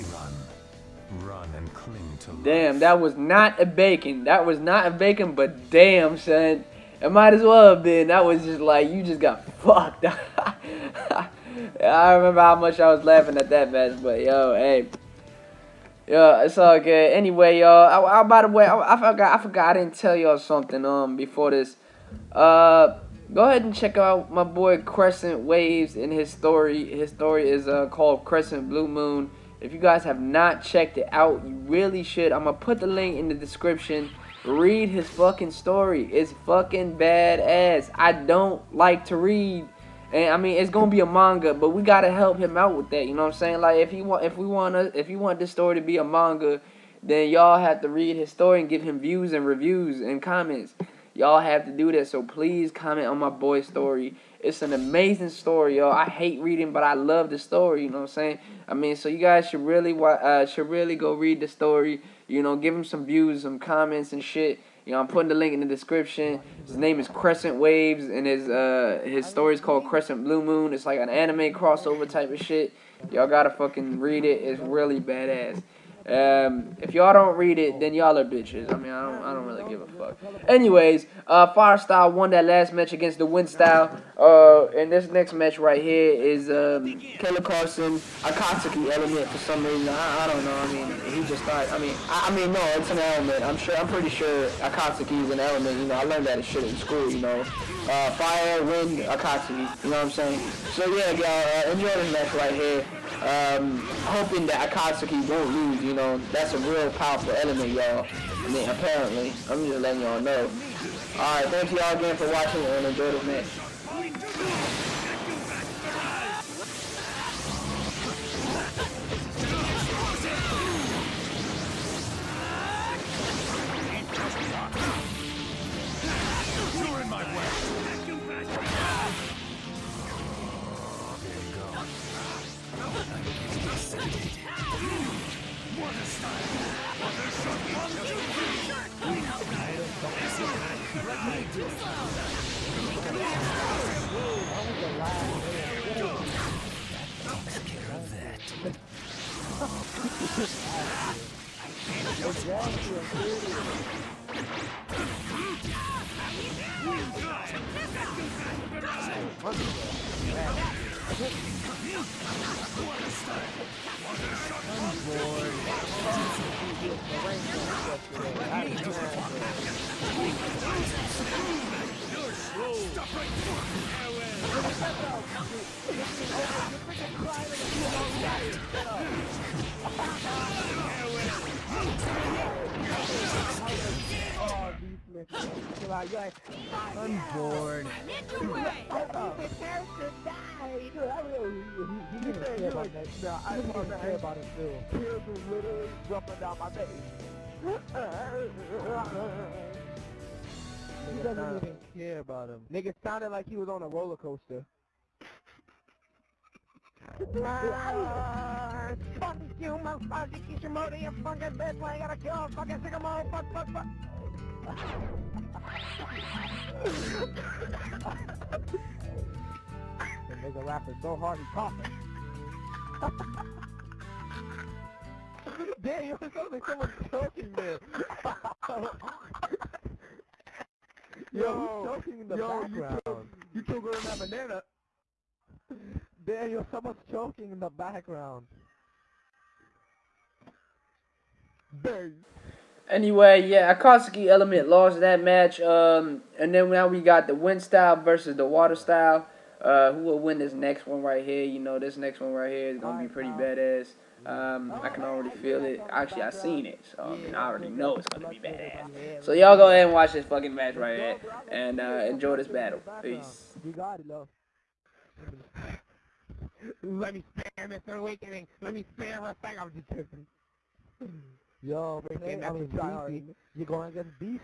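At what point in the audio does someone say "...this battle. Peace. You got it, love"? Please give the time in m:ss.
4:22.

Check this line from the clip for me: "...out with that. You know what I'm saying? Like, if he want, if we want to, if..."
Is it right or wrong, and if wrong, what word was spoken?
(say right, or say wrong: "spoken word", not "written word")
right.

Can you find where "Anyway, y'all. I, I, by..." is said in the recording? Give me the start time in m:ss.
0:17.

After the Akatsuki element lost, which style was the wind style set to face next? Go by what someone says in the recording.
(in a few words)
Water style.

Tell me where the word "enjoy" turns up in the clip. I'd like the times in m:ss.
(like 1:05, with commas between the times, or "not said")
1:41, 1:52, 4:22.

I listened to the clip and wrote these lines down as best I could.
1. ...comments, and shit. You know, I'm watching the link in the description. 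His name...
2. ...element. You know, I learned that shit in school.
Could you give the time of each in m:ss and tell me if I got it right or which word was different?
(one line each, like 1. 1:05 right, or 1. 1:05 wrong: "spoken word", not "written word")
1. 1:03 wrong: "putting", not "watching"
2. 1:35 right.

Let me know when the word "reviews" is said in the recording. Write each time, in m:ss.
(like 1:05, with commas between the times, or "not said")
0:49.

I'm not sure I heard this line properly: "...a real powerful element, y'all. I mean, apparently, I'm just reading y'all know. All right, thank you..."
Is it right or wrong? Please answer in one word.
wrong.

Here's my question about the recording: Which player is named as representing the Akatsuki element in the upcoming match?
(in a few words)
Killer Carson.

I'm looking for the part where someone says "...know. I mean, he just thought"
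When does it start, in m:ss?
1:30.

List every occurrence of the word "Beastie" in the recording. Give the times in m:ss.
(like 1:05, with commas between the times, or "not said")
4:32.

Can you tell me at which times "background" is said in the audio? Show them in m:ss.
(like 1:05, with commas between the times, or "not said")
3:52, 3:57.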